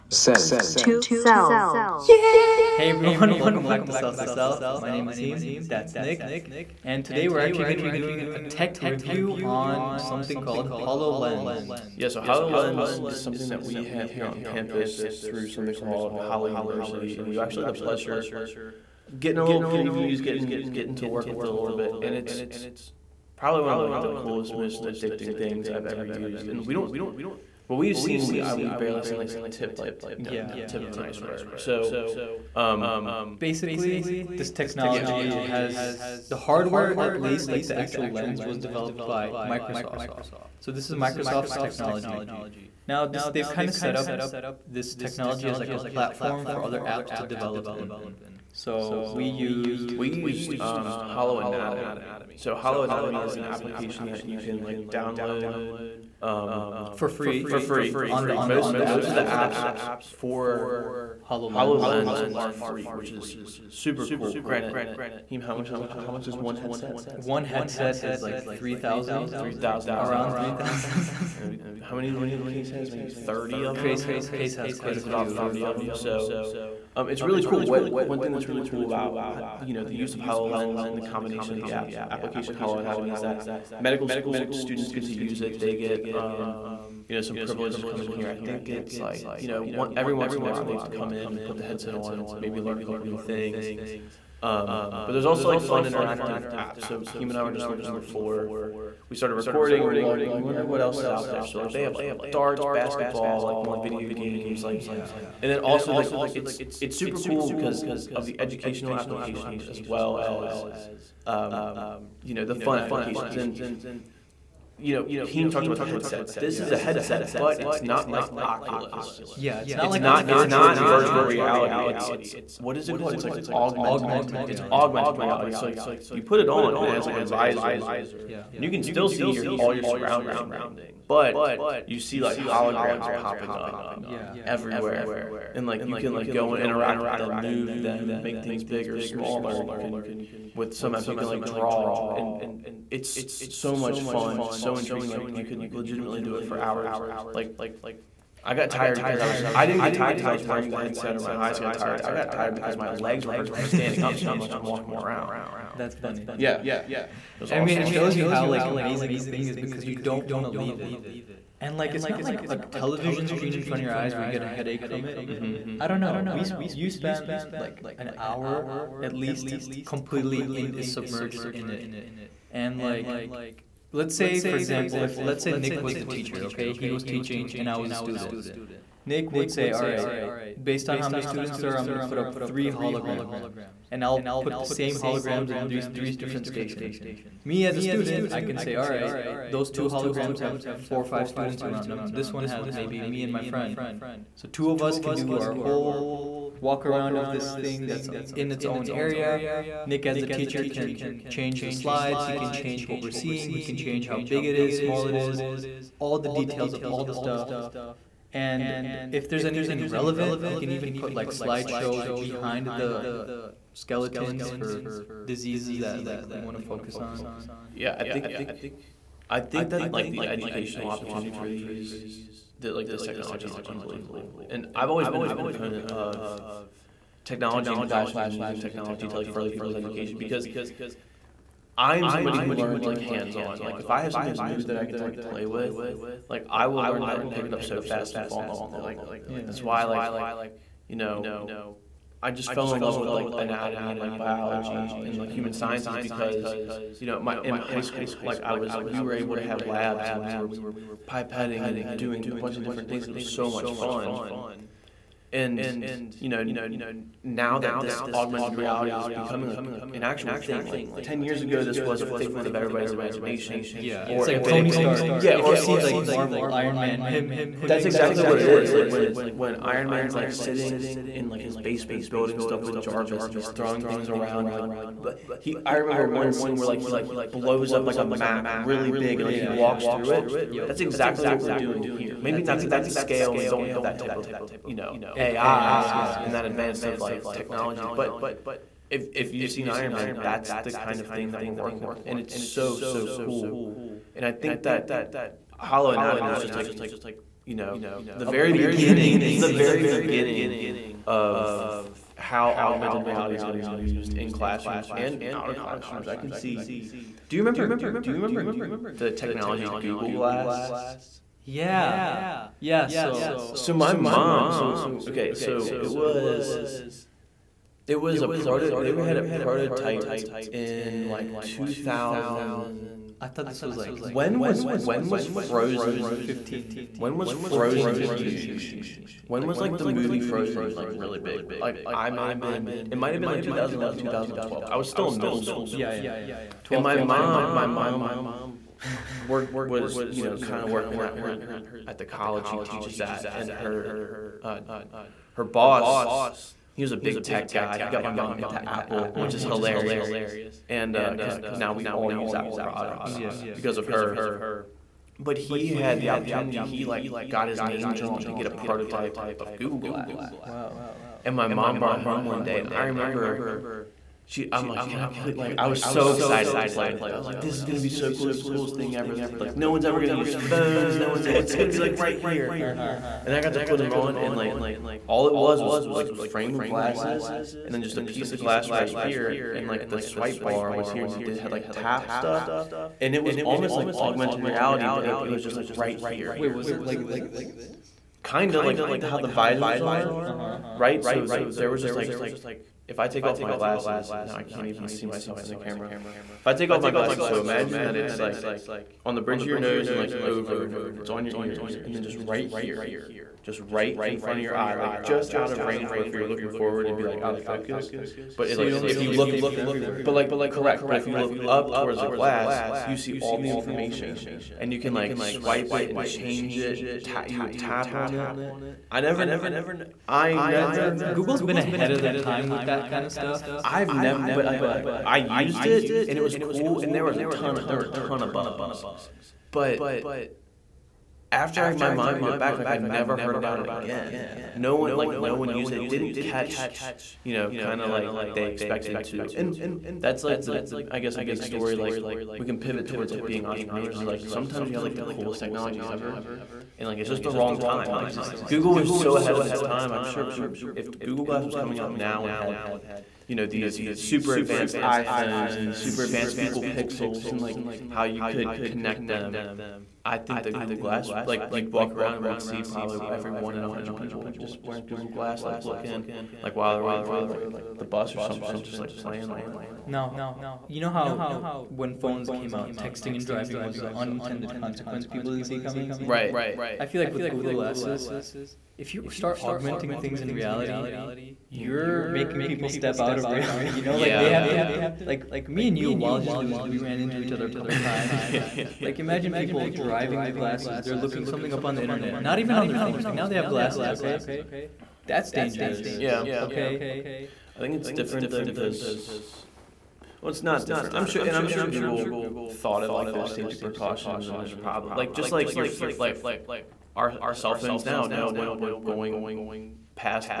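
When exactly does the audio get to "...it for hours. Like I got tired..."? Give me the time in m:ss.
2:26.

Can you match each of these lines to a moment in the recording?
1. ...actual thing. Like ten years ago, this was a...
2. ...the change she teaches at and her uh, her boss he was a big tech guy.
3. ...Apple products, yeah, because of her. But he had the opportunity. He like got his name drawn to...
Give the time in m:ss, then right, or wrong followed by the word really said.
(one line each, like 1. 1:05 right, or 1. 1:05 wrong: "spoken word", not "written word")
1. 4:20 right
2. 5:41 wrong: "college", not "change"
3. 5:52 right.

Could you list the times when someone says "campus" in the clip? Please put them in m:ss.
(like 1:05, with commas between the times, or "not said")
0:14.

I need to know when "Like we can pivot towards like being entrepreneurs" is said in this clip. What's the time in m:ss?
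7:21.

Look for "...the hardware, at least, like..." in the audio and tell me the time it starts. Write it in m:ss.
0:36.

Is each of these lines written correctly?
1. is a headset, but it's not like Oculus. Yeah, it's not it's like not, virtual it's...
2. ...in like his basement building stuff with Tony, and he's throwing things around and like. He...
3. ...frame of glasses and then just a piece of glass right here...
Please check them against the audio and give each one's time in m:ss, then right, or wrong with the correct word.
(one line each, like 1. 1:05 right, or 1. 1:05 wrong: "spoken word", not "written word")
1. 1:56 right
2. 4:31 wrong: "Jarvis", not "Tony"
3. 6:16 right.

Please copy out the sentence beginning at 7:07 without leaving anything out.
Of, there were a ton of bugs, but after I, my mom gave it back, like I never heard about it again.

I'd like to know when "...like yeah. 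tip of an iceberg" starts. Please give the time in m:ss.
0:29.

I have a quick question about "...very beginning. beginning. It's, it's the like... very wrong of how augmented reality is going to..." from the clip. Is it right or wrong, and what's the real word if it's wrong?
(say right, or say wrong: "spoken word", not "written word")
wrong: "beginning", not "wrong".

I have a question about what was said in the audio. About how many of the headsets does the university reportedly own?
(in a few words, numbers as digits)
30.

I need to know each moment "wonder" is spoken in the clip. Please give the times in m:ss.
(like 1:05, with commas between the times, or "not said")
1:40.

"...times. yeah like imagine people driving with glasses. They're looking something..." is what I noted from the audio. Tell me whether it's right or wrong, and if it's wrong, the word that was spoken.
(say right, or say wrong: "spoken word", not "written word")
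right.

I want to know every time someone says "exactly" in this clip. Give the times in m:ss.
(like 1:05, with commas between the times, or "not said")
4:27, 4:40.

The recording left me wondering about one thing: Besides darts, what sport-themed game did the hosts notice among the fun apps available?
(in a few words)
basketball.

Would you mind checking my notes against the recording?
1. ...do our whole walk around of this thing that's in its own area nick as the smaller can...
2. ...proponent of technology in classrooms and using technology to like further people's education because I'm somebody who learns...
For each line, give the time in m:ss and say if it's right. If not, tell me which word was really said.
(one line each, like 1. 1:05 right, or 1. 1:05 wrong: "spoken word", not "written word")
1. 3:15 wrong: "teacher", not "smaller"
2. 3:45 right.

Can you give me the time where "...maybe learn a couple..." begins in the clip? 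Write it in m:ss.
1:32.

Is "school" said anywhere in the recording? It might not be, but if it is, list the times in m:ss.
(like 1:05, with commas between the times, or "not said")
1:24, 4:07, 5:35.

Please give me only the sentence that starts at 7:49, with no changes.
Now, you know how when phones came out, texting and driving was the unintended consequence people didn't see coming.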